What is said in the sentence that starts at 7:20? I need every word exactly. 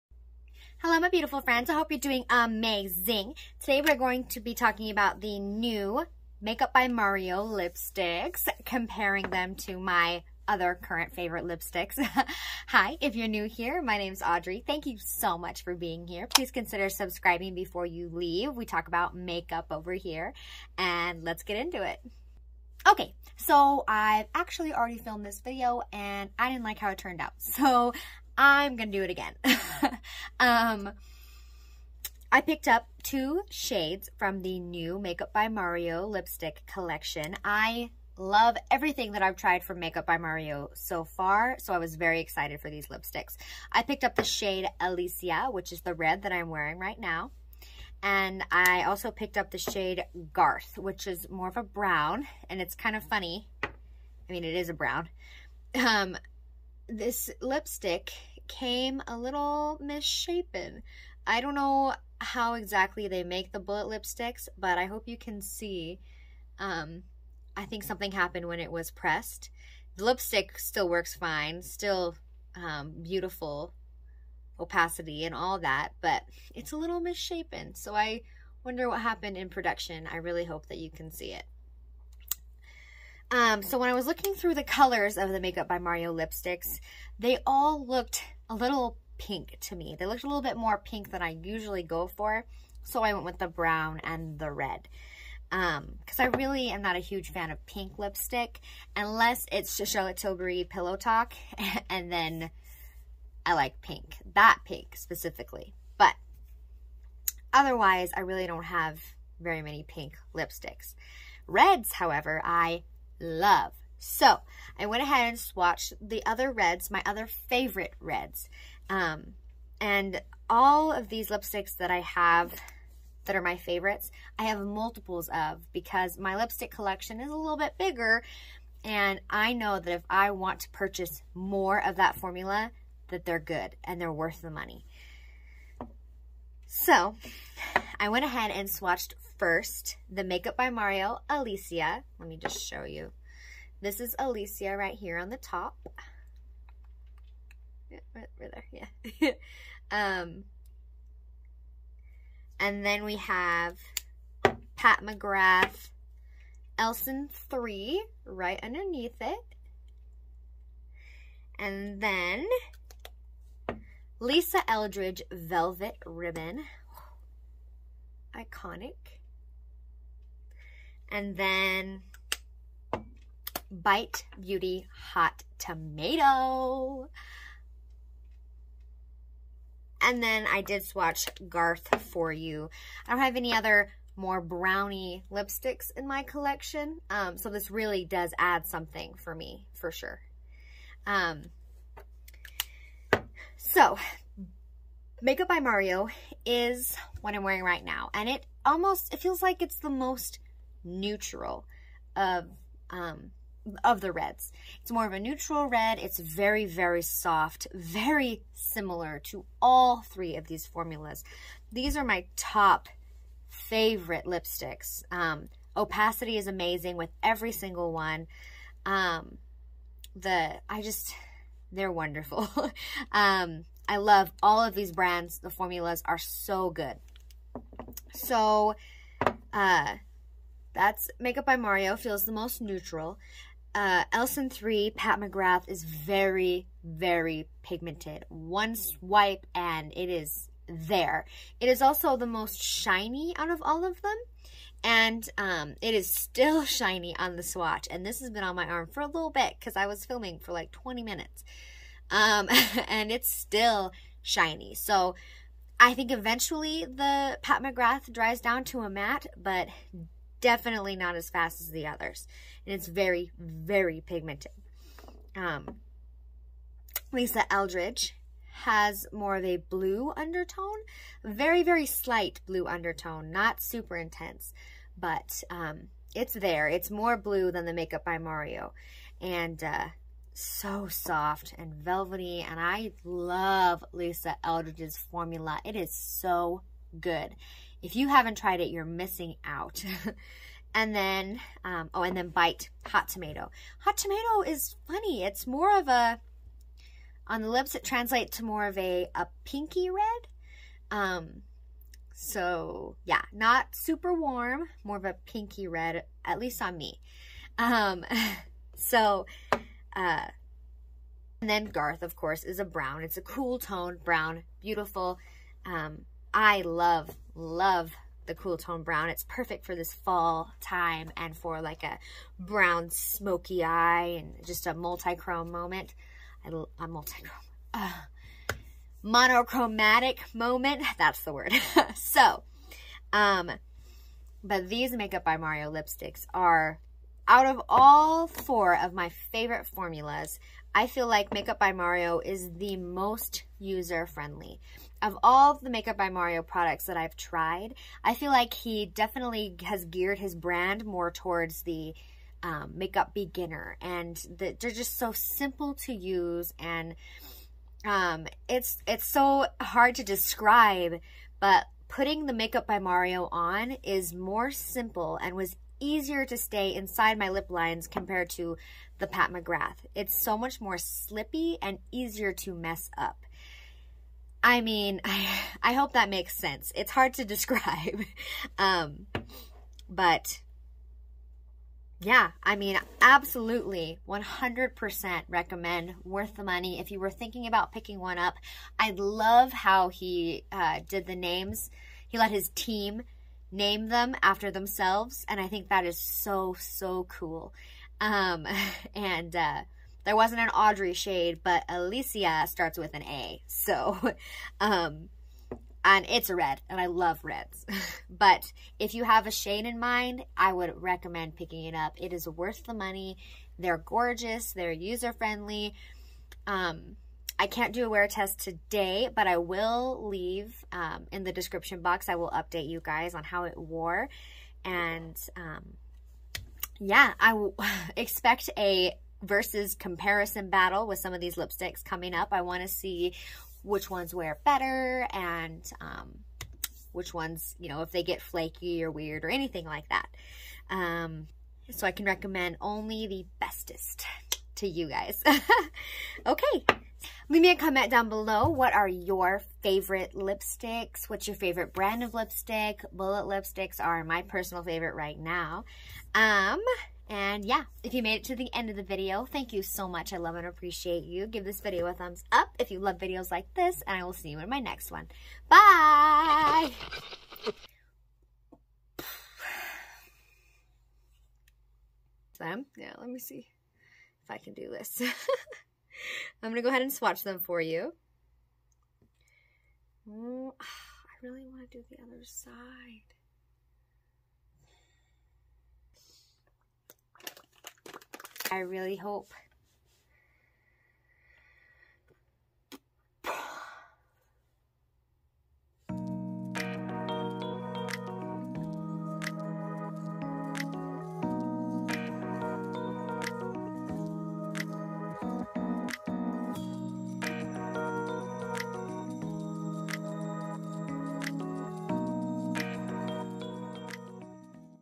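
Um, so I can recommend only the bestest to you guys.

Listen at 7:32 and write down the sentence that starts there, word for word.
Bullet lipsticks are my personal favorite right now.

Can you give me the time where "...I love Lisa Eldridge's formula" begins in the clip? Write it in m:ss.
4:42.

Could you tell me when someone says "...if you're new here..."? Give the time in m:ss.
0:12.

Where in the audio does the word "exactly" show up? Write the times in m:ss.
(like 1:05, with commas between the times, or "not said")
1:02.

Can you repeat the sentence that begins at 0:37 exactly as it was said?
I love everything that I've tried from Makeup by Mario so far, so I was very excited for these lipsticks.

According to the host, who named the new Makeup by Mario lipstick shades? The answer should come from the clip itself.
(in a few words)
His team.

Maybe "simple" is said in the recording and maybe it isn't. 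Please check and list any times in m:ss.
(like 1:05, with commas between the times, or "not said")
5:55, 6:04.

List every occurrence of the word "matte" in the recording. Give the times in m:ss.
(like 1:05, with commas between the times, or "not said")
4:18.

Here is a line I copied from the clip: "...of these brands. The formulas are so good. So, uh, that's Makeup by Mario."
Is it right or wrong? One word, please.
right.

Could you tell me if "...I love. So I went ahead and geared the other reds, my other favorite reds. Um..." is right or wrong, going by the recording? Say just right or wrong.
wrong.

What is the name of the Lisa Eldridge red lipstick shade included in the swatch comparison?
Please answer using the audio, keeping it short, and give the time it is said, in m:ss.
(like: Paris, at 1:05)
Velvet Ribbon, at 2:45.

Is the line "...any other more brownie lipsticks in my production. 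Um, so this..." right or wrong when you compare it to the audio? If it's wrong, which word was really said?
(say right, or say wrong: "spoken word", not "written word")
wrong: "collection", not "production".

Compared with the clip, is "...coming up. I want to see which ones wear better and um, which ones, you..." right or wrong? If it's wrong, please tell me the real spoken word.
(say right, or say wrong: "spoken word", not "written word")
right.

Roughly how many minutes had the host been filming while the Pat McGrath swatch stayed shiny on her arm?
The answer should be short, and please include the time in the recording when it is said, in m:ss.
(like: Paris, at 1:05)
20, at 4:10.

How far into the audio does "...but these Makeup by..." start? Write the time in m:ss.
5:34.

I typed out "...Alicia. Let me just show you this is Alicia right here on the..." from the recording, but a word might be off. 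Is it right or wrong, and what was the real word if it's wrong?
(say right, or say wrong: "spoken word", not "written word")
right.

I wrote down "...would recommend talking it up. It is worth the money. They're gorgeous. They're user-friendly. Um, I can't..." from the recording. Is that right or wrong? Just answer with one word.
wrong.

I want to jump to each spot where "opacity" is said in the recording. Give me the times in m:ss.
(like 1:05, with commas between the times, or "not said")
1:14, 3:35.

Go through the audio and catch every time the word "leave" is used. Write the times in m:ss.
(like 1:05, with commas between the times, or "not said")
0:18, 7:00, 7:27.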